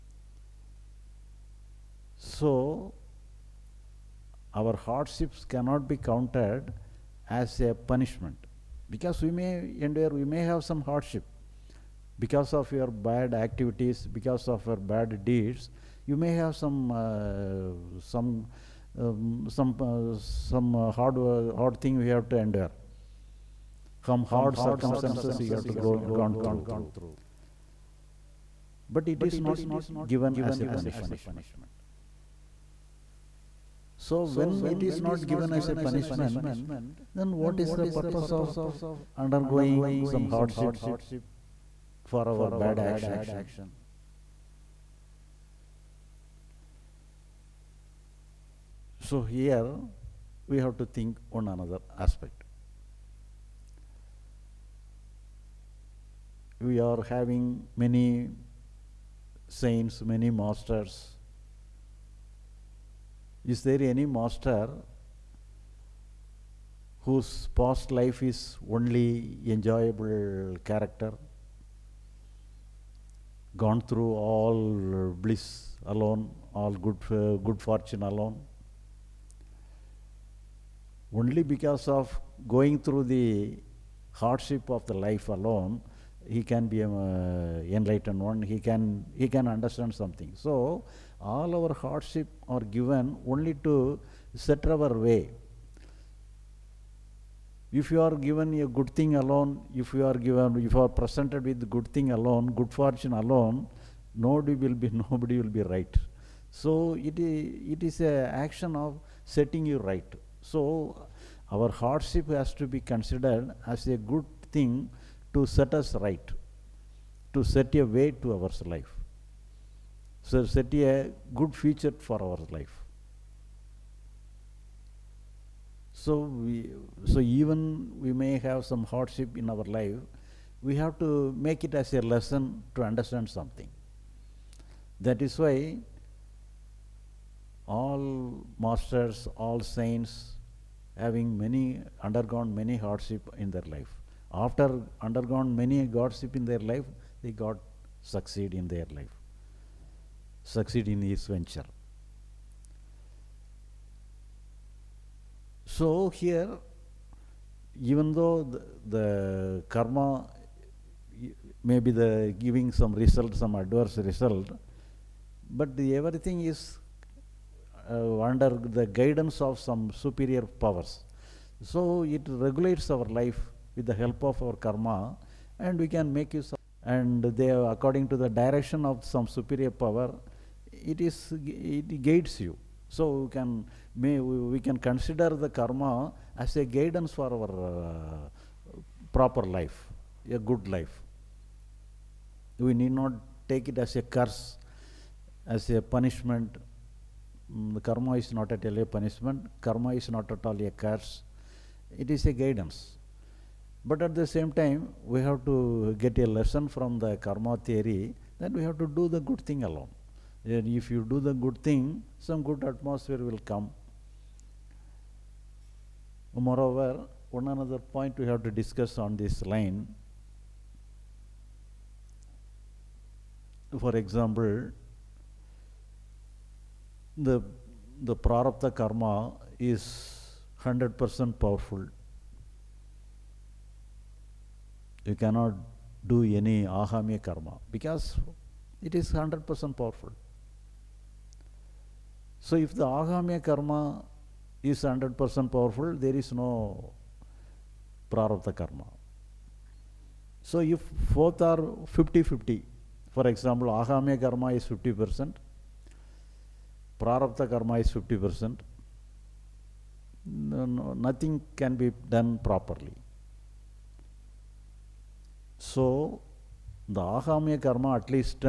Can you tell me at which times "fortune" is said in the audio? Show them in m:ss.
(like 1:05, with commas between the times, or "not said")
1:17, 1:42.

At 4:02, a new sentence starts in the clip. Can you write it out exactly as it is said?
So if the agamya karma is 100% powerful, there is no prarabdha karma.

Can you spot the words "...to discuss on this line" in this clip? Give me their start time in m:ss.
3:38.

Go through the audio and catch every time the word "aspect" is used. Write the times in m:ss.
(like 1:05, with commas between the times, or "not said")
0:52.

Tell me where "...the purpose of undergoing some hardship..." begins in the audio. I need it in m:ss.
0:37.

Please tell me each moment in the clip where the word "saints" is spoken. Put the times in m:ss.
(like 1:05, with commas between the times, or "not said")
0:59, 2:19.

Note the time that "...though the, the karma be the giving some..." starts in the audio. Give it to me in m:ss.
2:38.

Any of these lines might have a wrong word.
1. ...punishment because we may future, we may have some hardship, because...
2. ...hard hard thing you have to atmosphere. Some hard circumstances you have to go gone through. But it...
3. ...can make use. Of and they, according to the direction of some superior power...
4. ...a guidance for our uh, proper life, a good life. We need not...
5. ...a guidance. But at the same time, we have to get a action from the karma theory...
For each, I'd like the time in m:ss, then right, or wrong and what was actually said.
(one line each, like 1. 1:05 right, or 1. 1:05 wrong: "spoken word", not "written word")
1. 0:07 wrong: "endure", not "future"
2. 0:21 wrong: "endure", not "atmosphere"
3. 2:55 right
4. 3:06 right
5. 3:22 wrong: "lesson", not "action".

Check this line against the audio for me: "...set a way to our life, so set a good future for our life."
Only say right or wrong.
right.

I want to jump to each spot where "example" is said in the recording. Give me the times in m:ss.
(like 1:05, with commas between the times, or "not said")
3:43, 4:13.